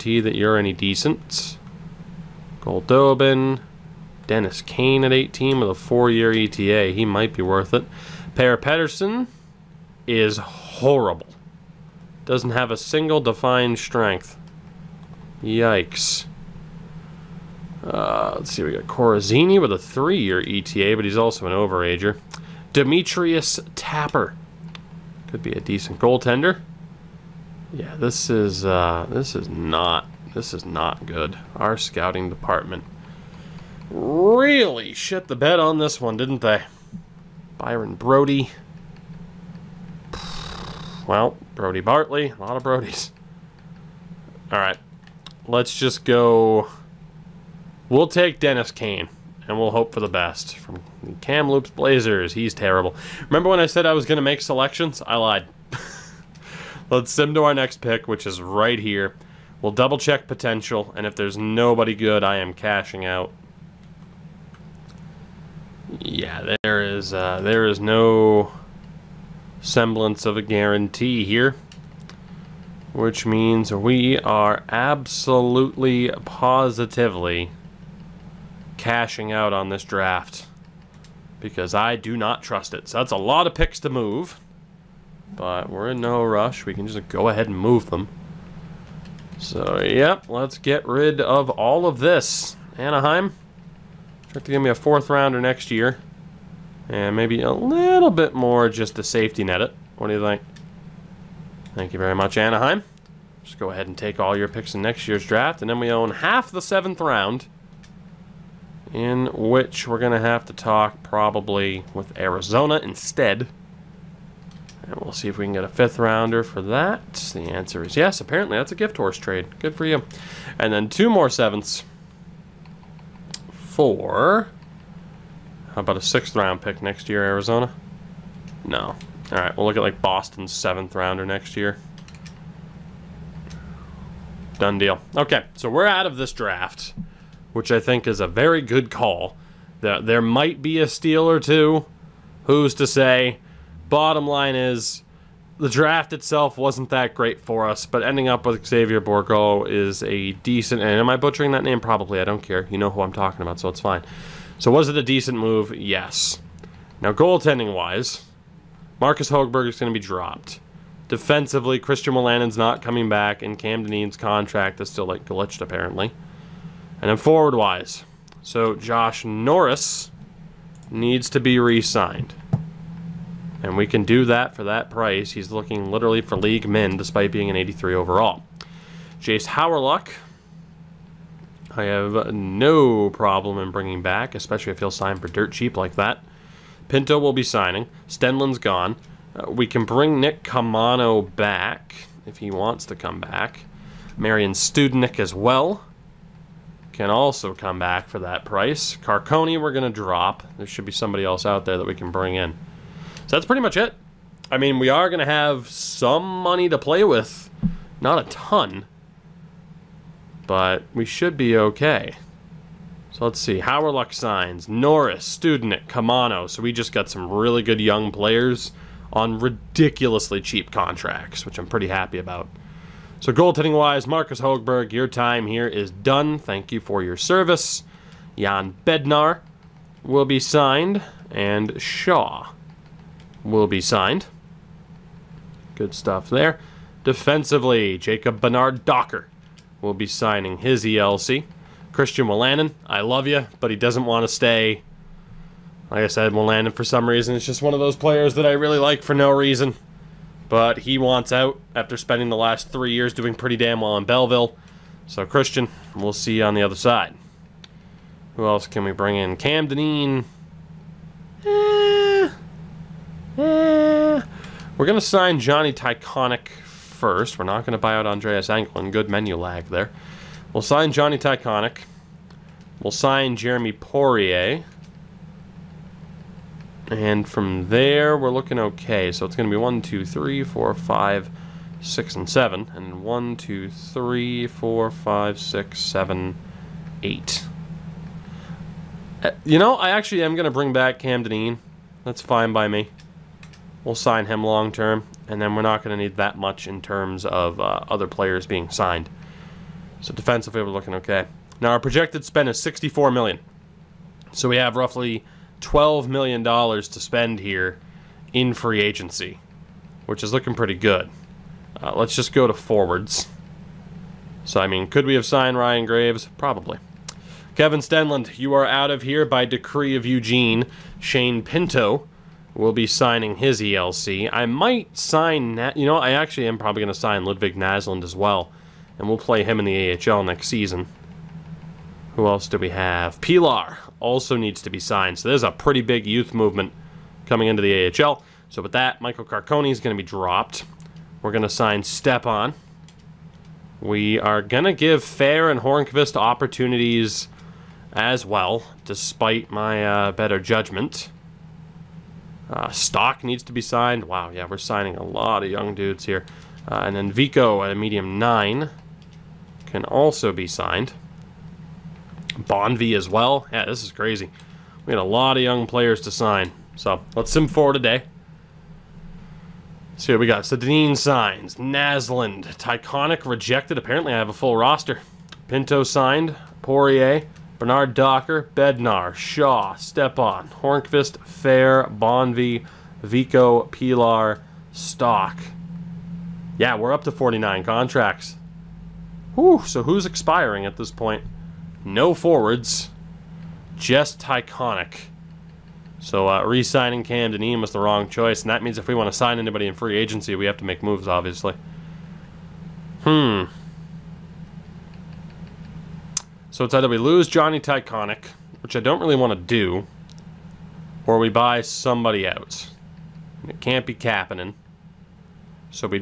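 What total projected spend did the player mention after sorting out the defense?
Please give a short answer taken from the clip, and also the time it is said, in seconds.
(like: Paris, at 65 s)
$64 million, at 302 s.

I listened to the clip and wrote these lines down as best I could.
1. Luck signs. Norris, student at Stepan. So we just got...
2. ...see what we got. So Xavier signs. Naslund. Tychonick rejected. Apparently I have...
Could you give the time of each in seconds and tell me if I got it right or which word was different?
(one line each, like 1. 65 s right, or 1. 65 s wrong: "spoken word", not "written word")
1. 213 s wrong: "Caamano", not "Stepan"
2. 370 s wrong: "Dineen", not "Xavier".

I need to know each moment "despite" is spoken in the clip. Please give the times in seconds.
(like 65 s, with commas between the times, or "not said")
176 s, 348 s.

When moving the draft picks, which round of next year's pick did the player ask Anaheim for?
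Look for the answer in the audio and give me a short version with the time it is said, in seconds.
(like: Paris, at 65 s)
fourth, at 94 s.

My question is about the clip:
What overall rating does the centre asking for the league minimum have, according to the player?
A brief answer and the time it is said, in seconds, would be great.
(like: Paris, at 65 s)
83, at 177 s.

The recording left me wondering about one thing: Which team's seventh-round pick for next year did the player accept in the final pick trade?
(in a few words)
Boston.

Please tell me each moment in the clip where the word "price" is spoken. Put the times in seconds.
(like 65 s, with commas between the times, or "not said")
174 s, 198 s.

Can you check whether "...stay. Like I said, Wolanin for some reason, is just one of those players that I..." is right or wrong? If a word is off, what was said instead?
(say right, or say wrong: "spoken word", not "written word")
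right.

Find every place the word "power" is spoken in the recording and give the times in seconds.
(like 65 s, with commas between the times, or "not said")
not said.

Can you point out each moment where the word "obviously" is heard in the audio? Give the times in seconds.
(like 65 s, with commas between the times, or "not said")
401 s.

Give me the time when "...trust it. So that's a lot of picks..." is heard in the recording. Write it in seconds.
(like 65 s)
82 s.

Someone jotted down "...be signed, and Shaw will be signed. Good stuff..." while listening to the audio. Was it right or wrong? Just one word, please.
right.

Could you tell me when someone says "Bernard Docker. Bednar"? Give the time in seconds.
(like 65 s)
377 s.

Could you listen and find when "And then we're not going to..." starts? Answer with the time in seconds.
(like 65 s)
295 s.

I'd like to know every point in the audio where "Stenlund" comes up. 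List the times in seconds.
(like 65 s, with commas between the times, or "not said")
188 s, 317 s.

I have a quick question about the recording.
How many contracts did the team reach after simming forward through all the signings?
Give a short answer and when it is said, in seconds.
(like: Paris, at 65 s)
49, at 387 s.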